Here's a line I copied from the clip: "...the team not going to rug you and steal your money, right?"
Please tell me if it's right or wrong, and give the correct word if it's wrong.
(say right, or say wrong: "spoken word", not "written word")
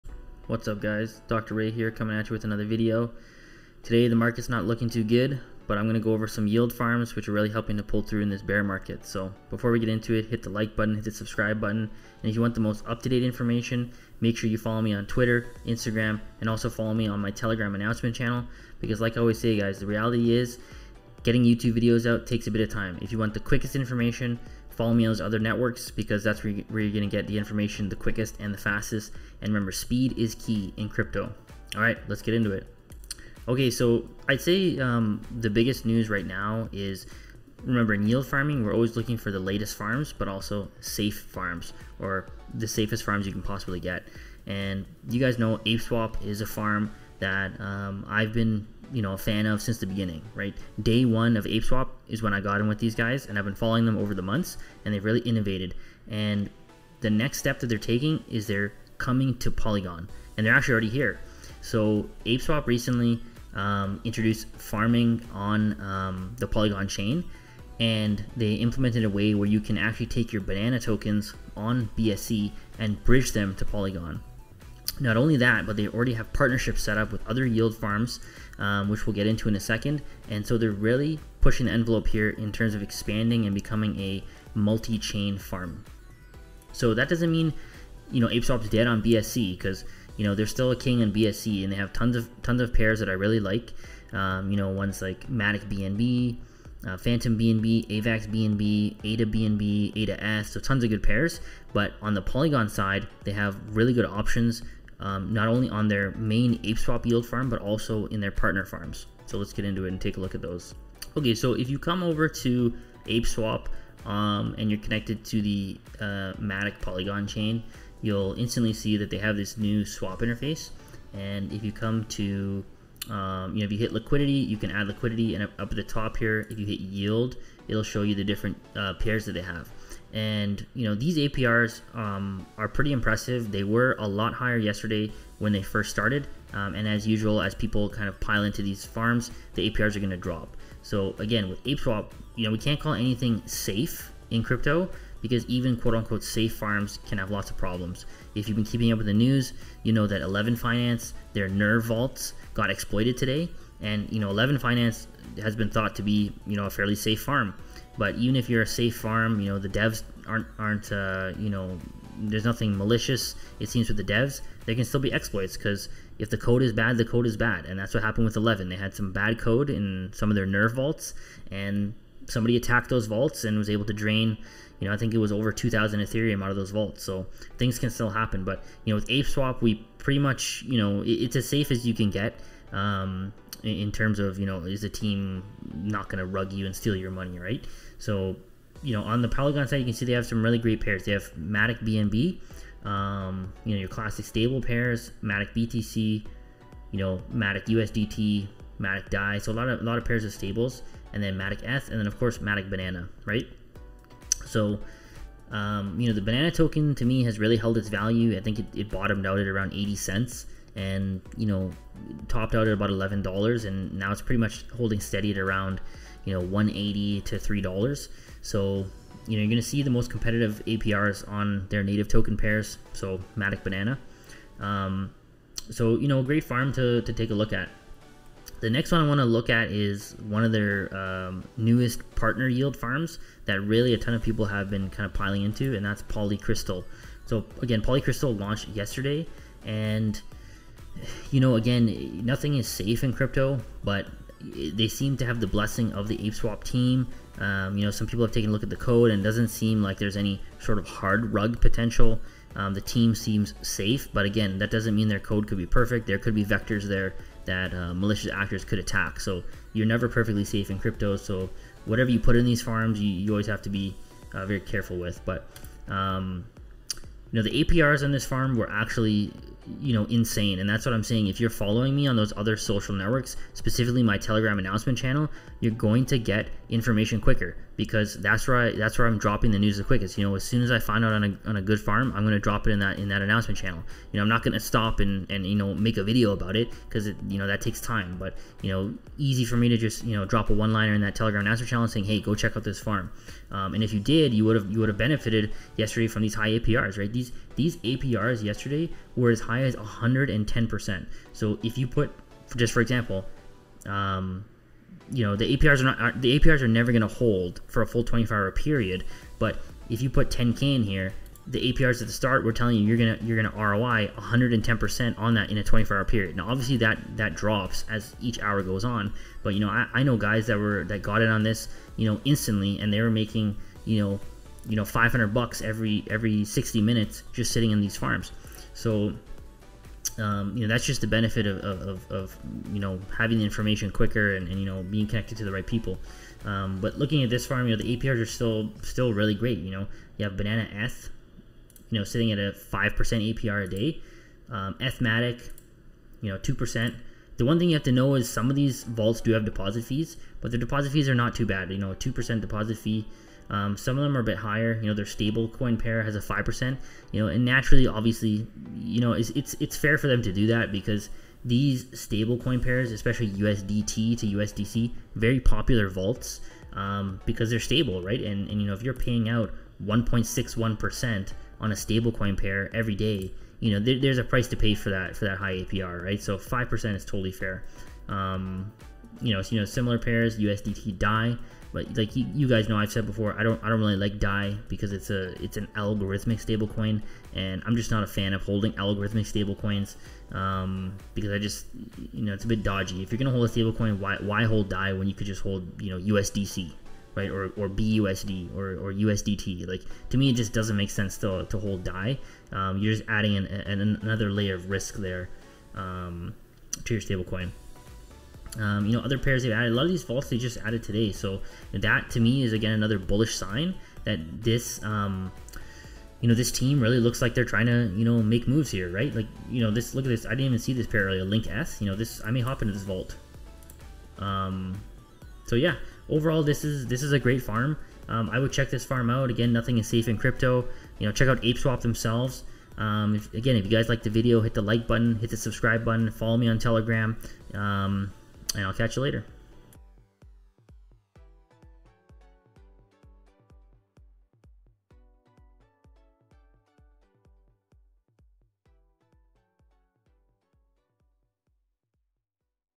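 right.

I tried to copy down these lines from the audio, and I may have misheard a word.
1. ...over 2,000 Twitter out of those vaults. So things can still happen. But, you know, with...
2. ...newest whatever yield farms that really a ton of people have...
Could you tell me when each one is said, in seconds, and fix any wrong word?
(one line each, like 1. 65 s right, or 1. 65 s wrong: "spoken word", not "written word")
1. 175 s wrong: "Ethereum", not "Twitter"
2. 231 s wrong: "partner", not "whatever".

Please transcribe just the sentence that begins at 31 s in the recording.
All right, let's get into it.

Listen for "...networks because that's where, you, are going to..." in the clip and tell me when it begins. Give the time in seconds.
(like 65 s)
25 s.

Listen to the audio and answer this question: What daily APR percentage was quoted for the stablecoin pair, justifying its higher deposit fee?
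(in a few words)
1.61%.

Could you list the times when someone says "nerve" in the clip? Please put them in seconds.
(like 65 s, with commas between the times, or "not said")
151 s, 170 s.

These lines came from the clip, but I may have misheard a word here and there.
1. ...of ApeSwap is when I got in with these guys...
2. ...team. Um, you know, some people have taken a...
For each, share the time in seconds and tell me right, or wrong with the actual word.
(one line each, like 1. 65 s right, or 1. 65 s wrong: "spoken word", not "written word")
1. 51 s right
2. 246 s right.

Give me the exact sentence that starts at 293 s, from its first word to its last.
Um, and if you did, you would have you would have benefited yesterday from these high APRs, right?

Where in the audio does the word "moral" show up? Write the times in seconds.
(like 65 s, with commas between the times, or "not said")
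not said.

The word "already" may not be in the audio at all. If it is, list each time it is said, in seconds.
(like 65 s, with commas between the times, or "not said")
60 s, 75 s.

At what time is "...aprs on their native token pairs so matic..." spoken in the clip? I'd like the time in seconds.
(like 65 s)
220 s.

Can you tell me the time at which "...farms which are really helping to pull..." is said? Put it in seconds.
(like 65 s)
6 s.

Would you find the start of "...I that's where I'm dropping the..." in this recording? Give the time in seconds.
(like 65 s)
278 s.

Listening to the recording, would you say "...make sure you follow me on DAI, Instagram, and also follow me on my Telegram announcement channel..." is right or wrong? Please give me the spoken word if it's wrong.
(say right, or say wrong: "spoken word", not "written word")
wrong: "Twitter", not "DAI".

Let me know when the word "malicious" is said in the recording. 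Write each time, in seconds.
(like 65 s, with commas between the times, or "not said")
162 s, 257 s.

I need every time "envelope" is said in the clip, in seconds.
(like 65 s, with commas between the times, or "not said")
81 s.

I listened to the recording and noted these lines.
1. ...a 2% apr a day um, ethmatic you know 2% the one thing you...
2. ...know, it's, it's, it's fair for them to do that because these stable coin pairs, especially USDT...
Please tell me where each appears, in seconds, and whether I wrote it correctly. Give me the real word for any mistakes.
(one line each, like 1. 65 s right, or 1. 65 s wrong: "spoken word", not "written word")
1. 342 s wrong: "5", not "2"
2. 359 s right.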